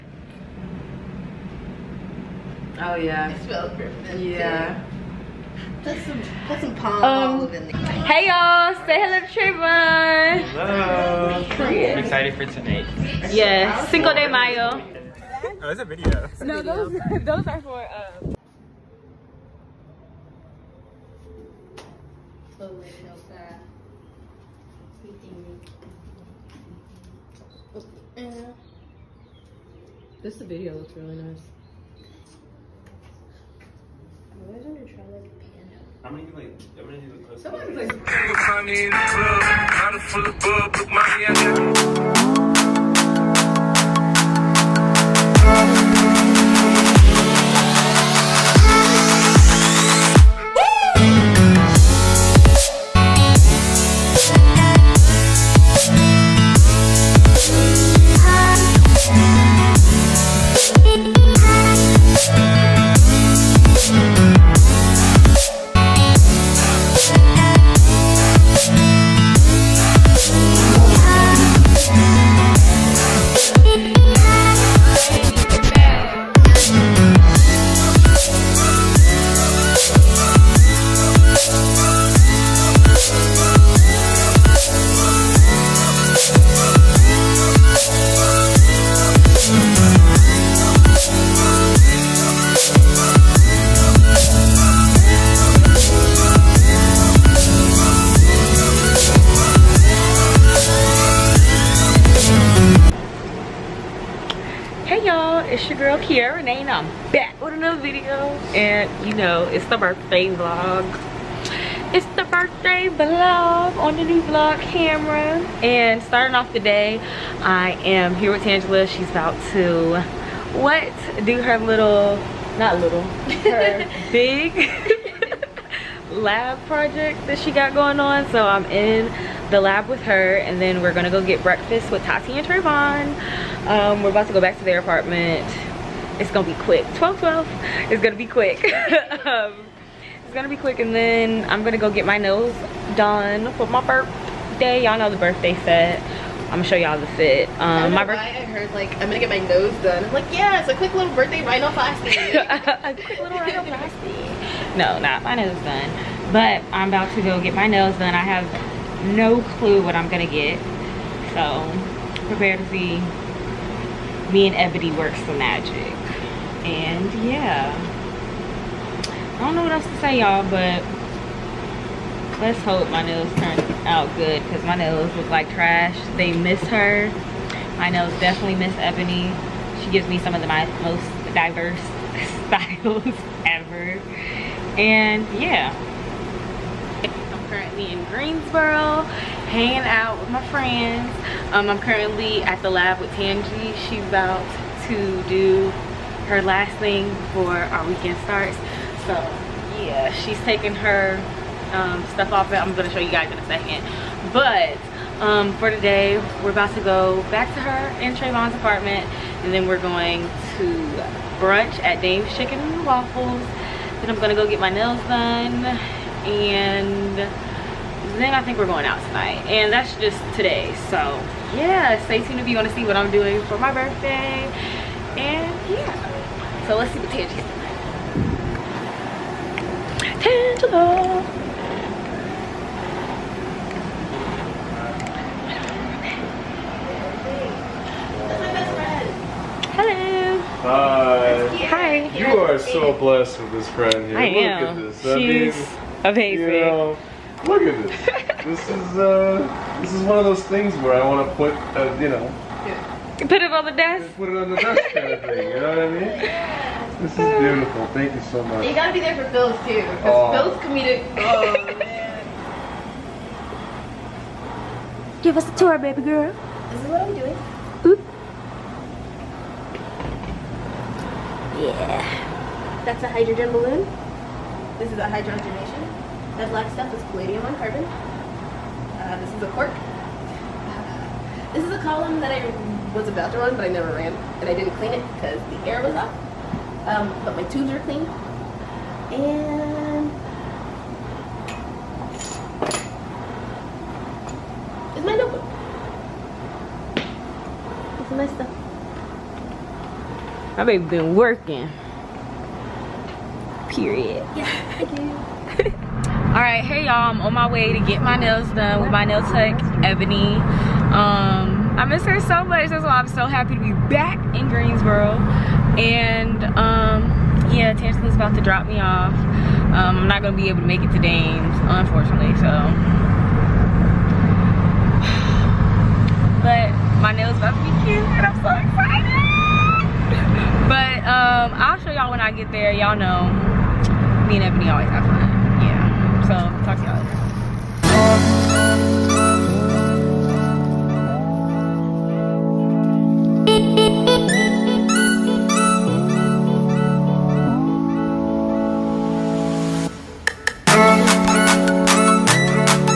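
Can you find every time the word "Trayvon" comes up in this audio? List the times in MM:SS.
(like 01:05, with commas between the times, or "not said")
00:09, 02:12, 03:28.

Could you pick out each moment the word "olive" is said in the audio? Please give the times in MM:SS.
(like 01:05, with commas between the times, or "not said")
00:07.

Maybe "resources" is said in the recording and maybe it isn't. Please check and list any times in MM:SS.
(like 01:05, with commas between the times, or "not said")
not said.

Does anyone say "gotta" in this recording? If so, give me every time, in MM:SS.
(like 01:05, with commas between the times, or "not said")
04:18.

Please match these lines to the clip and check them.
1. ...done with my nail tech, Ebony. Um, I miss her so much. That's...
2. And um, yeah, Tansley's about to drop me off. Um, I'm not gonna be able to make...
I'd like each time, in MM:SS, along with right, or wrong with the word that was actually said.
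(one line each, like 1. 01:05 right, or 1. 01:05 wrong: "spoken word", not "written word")
1. 05:08 right
2. 05:15 right.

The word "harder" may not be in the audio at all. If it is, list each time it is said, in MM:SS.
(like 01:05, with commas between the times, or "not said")
not said.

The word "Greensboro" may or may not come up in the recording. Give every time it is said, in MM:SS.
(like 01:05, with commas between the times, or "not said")
03:08, 05:14.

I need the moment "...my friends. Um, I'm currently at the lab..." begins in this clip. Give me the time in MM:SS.
03:10.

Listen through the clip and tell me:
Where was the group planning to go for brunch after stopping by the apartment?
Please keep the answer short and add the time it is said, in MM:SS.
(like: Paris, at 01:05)
Dame's Chicken and Waffles, at 03:31.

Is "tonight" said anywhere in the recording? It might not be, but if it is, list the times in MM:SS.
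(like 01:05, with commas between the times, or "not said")
00:12, 03:39.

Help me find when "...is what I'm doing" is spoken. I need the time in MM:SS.
04:26.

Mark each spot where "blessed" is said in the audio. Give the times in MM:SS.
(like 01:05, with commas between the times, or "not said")
04:02.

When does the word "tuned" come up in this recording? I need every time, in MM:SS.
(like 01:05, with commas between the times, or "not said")
03:42.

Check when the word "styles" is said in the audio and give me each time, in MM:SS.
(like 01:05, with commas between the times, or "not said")
03:02.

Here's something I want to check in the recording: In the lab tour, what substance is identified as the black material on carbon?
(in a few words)
Palladium.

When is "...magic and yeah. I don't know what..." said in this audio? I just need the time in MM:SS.
02:45.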